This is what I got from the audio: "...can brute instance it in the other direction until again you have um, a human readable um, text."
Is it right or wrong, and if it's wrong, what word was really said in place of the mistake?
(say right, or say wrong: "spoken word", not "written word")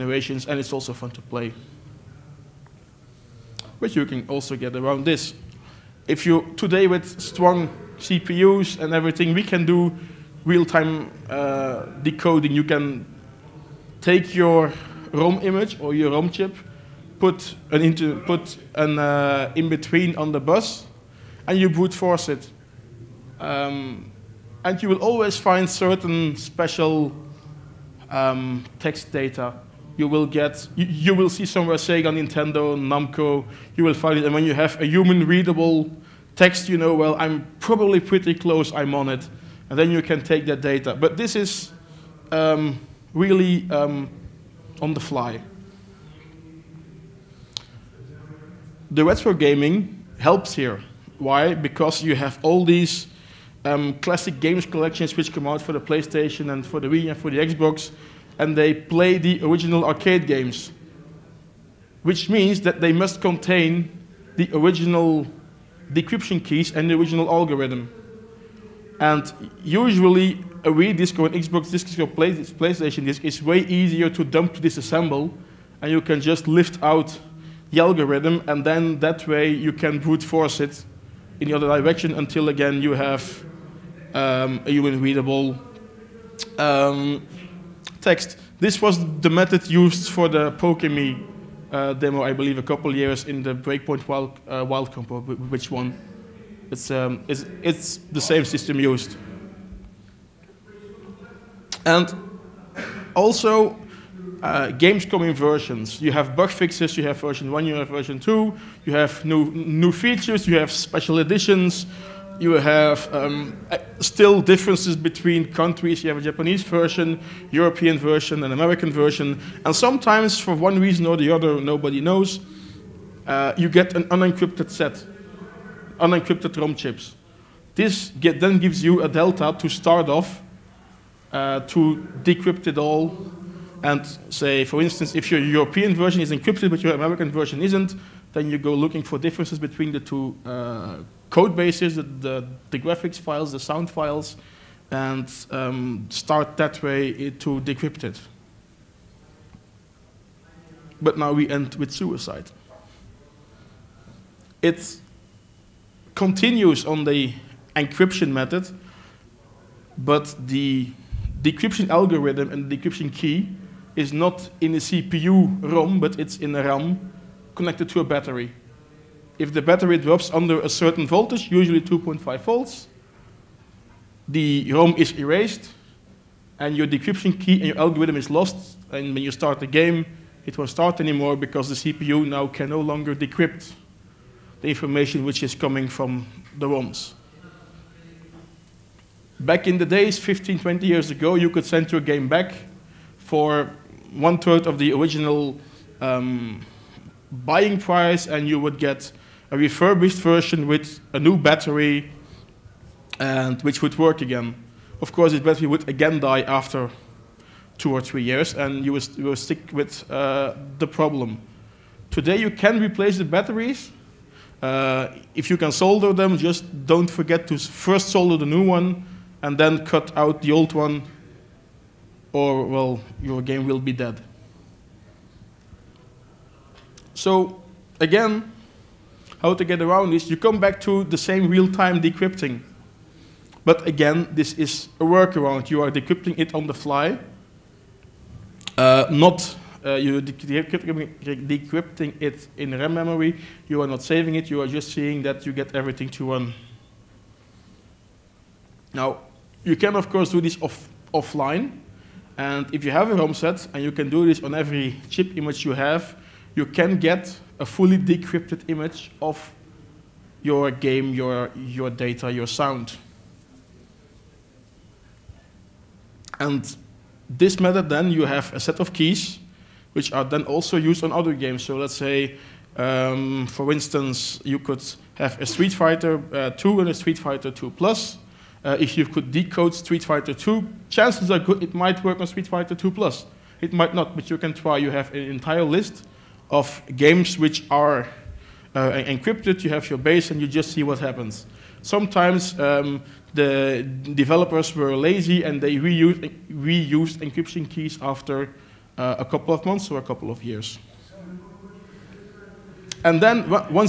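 wrong: "force", not "instance".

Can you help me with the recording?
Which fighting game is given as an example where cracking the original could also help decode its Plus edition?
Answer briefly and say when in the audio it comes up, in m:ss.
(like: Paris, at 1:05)
Street Fighter 2, at 4:35.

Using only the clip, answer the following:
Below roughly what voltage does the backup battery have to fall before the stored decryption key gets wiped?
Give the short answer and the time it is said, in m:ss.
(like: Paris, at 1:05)
2.5 volts, at 2:51.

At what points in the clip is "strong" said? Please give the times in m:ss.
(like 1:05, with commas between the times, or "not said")
0:07.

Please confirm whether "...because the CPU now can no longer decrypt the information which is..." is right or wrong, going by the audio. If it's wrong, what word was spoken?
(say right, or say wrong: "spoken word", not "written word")
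right.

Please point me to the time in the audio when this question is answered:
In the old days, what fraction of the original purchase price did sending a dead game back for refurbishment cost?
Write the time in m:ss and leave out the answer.
3:14.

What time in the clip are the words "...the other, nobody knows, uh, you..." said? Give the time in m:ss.
2:01.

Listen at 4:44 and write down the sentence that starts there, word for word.
You have an entire list of games which are uh, encrypted.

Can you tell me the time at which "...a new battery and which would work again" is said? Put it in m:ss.
3:21.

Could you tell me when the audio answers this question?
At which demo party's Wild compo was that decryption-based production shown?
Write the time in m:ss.
1:33.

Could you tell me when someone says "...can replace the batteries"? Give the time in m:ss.
3:32.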